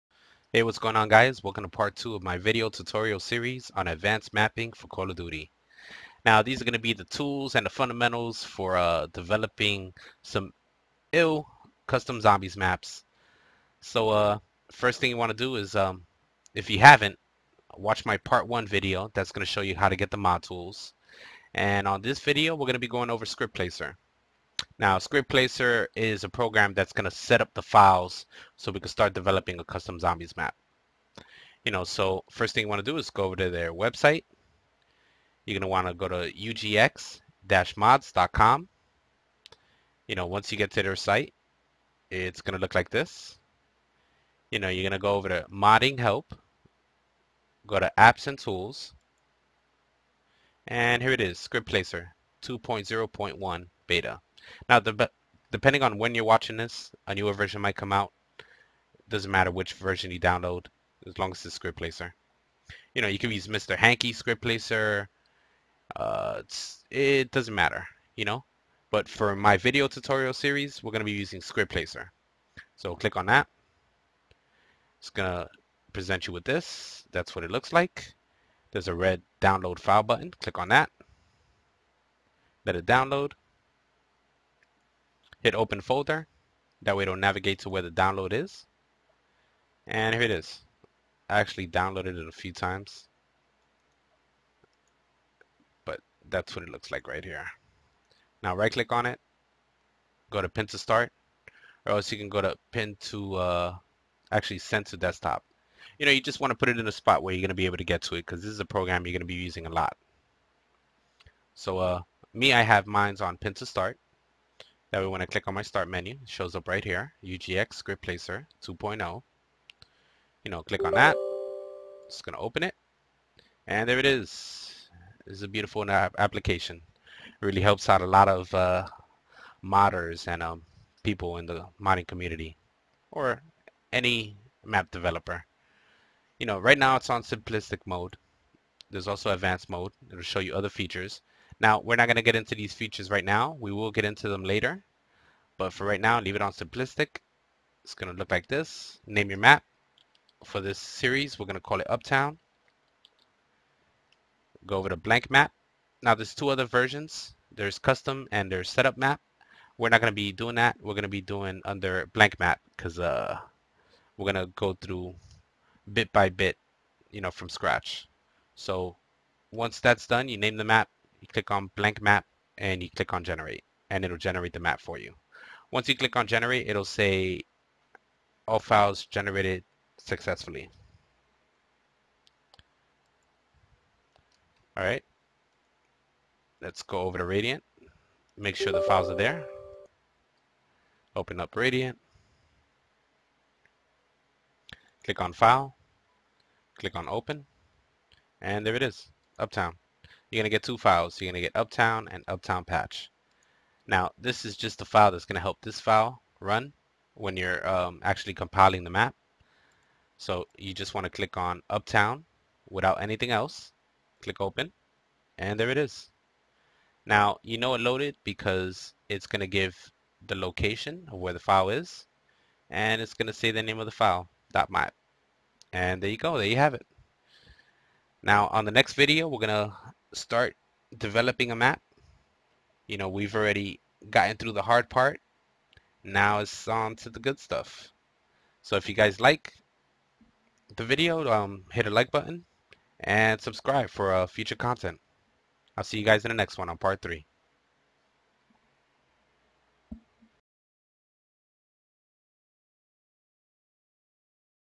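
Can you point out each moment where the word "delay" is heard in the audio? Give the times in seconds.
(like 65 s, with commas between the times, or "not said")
not said.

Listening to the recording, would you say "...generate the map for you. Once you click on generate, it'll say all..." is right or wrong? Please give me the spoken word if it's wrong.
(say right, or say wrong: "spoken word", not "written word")
right.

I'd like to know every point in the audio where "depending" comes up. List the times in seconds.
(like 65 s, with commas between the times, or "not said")
55 s.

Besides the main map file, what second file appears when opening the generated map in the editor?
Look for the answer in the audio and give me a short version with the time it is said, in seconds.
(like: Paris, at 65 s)
Uptown Patch, at 202 s.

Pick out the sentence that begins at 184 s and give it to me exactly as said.
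All right, let's go over to Radiant.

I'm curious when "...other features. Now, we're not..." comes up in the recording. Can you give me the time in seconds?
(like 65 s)
140 s.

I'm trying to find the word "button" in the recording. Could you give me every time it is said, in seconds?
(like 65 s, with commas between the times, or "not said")
80 s, 242 s.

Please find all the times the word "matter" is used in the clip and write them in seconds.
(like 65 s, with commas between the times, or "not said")
59 s, 67 s.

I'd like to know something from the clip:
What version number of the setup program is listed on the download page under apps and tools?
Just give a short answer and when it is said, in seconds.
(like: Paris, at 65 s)
2.0.1 beta, at 52 s.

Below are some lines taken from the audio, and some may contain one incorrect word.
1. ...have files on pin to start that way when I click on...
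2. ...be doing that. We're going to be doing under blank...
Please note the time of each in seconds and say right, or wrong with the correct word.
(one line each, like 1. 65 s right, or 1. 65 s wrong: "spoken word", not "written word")
1. 112 s wrong: "mines", not "files"
2. 160 s right.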